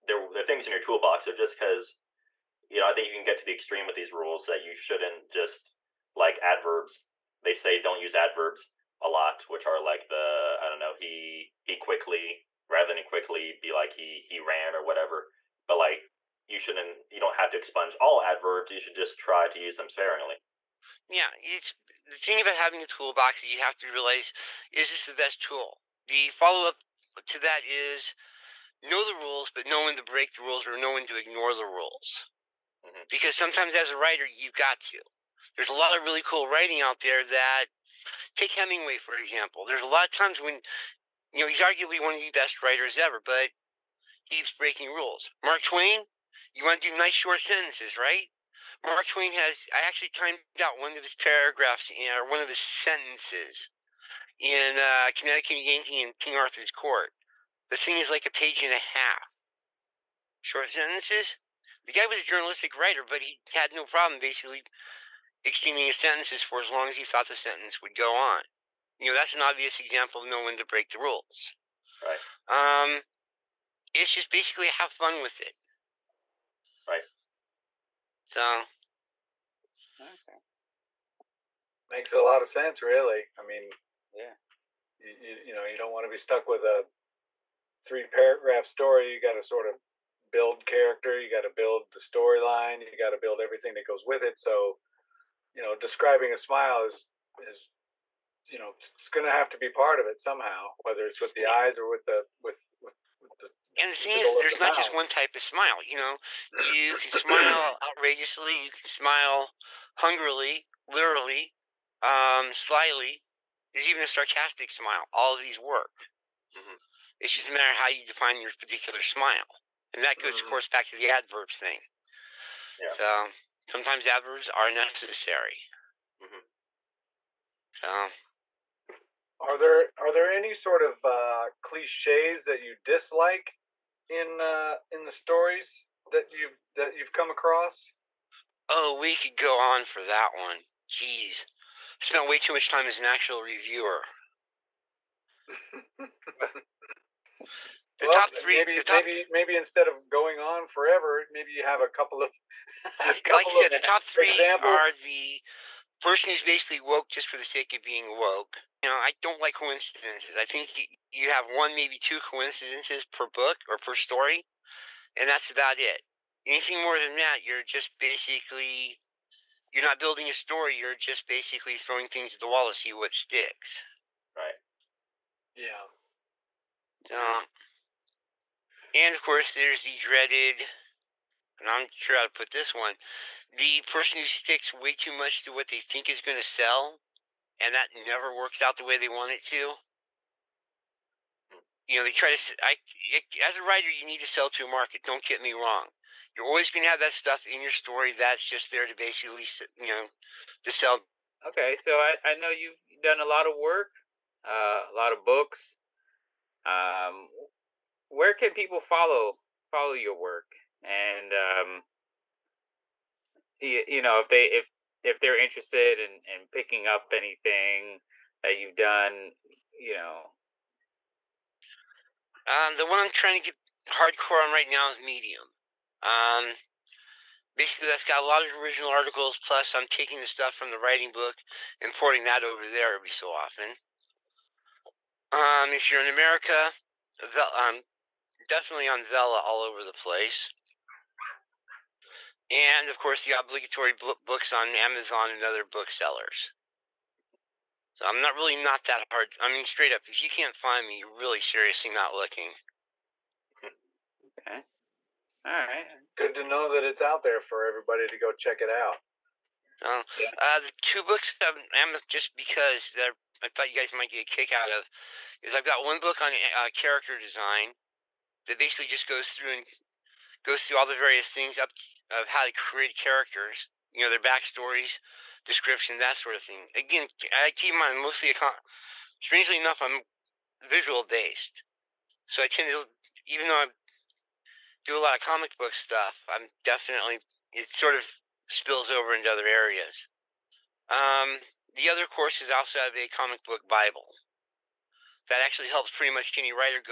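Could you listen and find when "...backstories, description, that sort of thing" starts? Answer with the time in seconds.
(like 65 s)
274 s.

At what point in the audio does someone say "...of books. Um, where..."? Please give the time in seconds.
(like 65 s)
205 s.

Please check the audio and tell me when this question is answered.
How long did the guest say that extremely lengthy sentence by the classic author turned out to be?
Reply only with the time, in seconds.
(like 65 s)
58 s.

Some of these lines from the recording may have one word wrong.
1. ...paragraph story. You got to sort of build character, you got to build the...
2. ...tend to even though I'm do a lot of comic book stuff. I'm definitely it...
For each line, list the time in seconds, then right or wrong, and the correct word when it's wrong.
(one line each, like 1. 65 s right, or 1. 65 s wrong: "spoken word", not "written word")
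1. 88 s right
2. 282 s right.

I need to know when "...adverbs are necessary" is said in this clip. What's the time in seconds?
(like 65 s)
124 s.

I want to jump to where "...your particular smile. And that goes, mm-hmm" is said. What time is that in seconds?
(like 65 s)
118 s.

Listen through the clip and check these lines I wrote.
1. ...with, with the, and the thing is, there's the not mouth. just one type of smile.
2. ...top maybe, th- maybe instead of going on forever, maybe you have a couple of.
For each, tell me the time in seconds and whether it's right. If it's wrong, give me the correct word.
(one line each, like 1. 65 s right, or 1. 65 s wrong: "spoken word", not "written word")
1. 102 s right
2. 148 s right.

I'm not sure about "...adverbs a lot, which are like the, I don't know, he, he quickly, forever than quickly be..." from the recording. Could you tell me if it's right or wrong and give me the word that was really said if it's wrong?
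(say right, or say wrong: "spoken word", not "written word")
wrong: "rather", not "forever".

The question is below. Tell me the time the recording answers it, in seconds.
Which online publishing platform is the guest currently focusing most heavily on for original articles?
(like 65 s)
224 s.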